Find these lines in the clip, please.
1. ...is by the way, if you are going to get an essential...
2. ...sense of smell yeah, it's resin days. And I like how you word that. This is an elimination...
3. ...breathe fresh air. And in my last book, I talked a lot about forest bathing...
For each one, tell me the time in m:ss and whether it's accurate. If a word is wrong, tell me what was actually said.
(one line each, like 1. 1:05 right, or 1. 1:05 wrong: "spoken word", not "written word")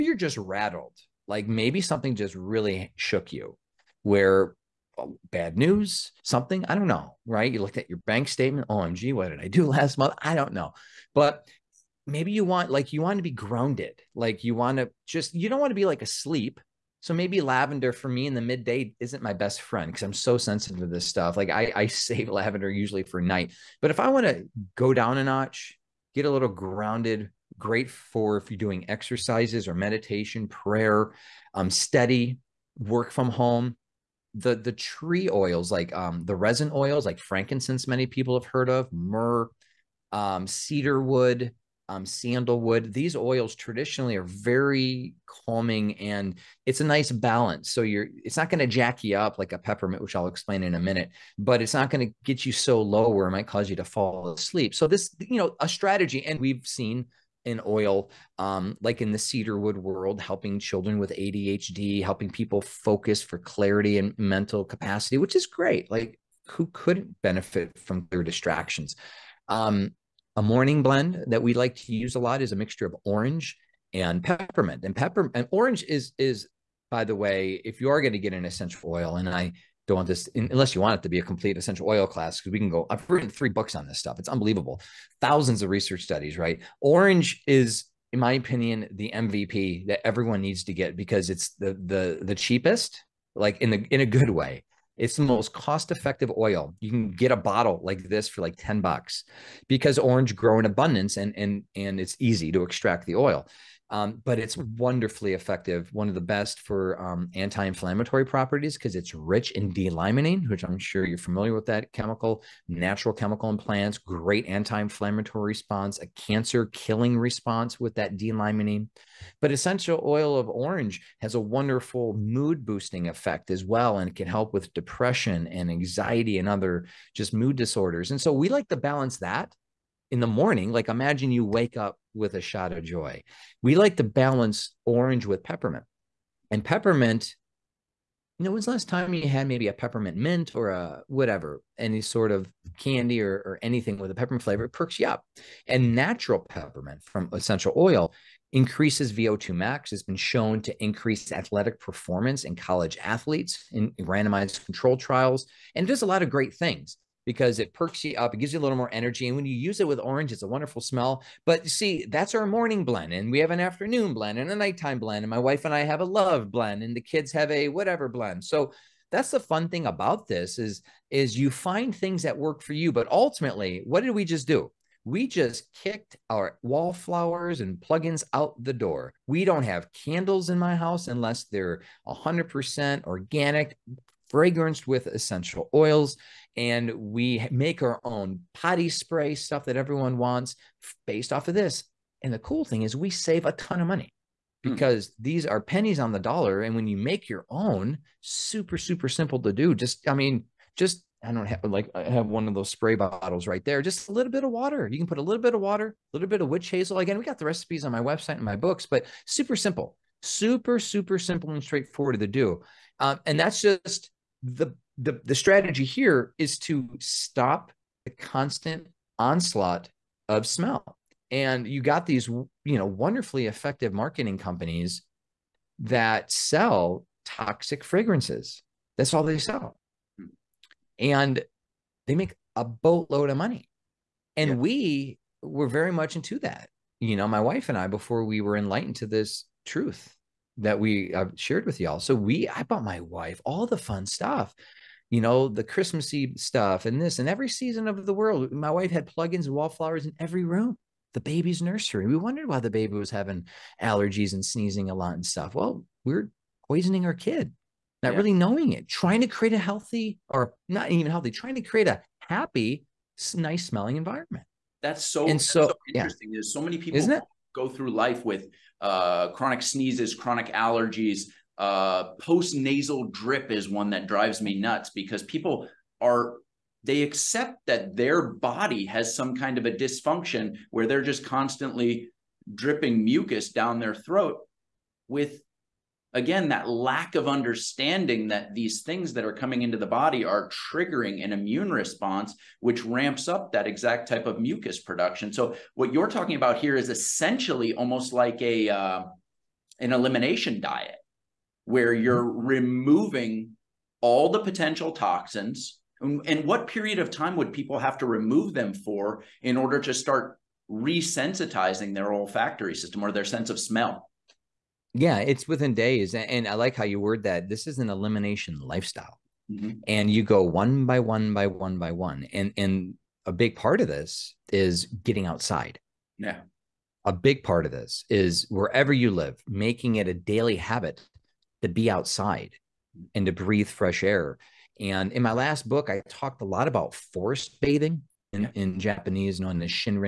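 1. 1:16 right
2. 5:13 wrong: "within", not "resin"
3. 5:33 right.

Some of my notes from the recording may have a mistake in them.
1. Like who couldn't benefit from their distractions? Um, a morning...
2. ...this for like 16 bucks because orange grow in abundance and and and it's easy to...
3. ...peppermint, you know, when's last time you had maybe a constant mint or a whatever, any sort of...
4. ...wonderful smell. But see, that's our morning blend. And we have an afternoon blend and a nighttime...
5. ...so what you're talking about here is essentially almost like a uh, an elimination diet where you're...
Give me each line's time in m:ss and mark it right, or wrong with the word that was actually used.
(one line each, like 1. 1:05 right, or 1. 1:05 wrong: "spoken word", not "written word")
1. 1:05 right
2. 1:38 wrong: "10", not "16"
3. 2:16 wrong: "peppermint", not "constant"
4. 2:40 right
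5. 4:55 right.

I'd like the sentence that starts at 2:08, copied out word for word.
And so we like to balance that in the morning, like imagine you wake up with a shot of joy.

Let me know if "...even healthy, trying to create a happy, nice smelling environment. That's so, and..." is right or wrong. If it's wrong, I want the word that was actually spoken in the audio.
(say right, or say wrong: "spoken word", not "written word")
right.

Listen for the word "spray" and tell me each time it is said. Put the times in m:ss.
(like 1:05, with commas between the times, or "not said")
3:08, 3:22.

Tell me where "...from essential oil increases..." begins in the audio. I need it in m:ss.
2:27.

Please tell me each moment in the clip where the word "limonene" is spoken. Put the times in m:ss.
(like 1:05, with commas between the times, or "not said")
1:49, 1:58.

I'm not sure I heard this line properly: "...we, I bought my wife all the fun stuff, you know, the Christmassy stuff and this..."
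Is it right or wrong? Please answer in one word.
right.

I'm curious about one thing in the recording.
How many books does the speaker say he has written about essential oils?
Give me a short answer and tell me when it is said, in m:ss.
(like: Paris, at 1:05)
3, at 1:23.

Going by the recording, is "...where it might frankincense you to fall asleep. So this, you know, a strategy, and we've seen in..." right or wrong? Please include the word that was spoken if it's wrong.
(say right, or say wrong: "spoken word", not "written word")
wrong: "cause", not "frankincense".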